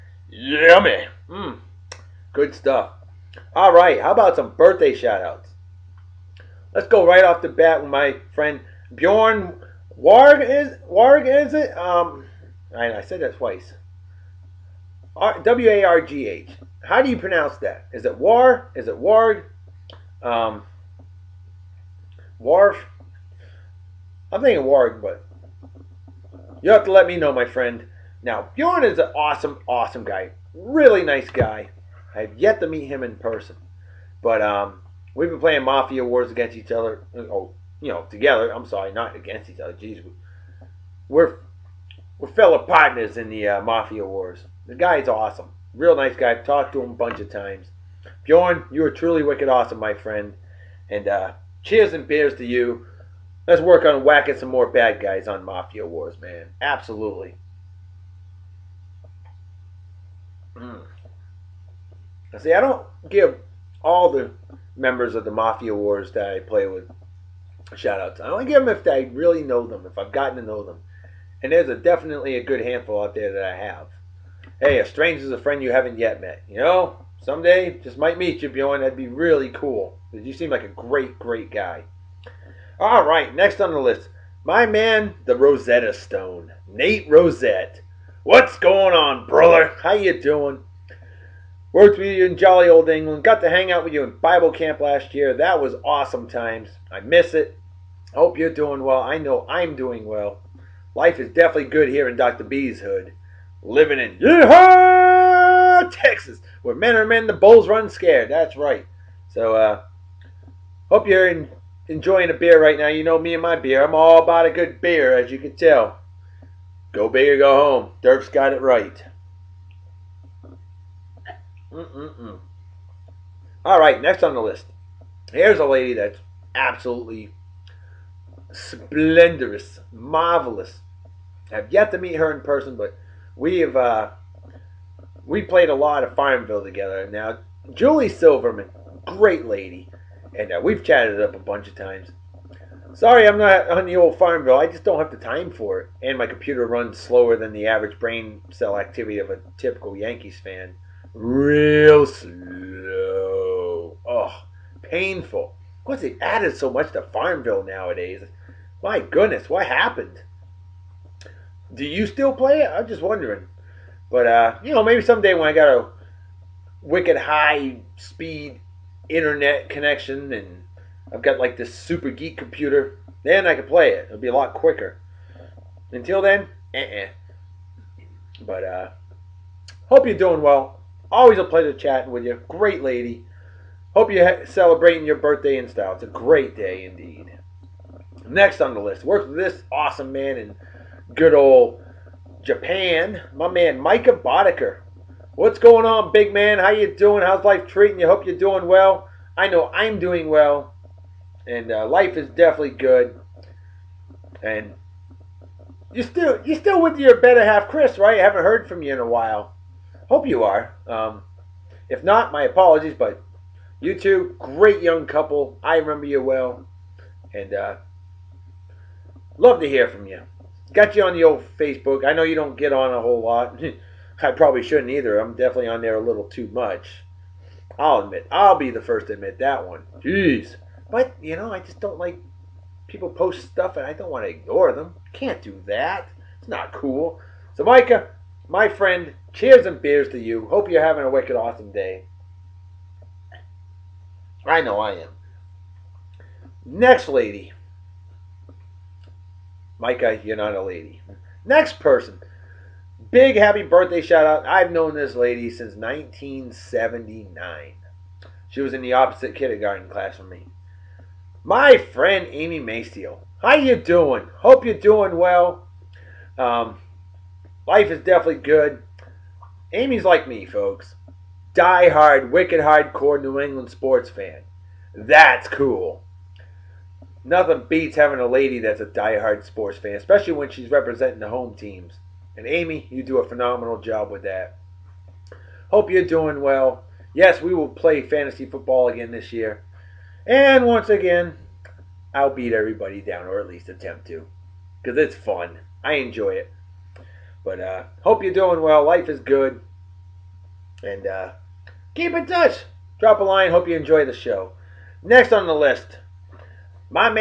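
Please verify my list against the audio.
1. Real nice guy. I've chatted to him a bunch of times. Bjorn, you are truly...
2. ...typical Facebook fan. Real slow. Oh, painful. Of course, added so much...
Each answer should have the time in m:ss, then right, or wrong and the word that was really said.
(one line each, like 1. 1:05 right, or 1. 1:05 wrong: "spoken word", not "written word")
1. 0:45 wrong: "talked", not "chatted"
2. 2:29 wrong: "Yankees", not "Facebook".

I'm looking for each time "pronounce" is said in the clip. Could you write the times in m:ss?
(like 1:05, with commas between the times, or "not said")
0:17.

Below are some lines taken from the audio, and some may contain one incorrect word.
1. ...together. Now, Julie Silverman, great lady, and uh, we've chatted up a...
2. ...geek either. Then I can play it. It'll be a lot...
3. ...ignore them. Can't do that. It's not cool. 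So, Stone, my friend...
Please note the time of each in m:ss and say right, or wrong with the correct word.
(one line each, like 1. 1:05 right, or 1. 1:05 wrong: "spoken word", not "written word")
1. 2:16 right
2. 2:52 wrong: "computer", not "either"
3. 3:54 wrong: "Micah", not "Stone".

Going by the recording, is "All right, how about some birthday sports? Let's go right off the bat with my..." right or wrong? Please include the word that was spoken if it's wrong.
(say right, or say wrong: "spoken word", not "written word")
wrong: "shoutouts", not "sports".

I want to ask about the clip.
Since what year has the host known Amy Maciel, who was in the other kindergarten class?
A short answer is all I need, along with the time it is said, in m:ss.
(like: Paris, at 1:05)
1979, at 4:15.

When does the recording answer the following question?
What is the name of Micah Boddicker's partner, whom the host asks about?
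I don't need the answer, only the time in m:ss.
3:27.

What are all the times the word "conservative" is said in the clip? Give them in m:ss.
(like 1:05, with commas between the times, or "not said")
not said.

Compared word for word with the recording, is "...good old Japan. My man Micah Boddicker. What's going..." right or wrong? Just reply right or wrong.
right.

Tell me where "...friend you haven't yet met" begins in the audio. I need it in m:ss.
1:15.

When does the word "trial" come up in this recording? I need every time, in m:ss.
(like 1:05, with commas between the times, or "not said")
not said.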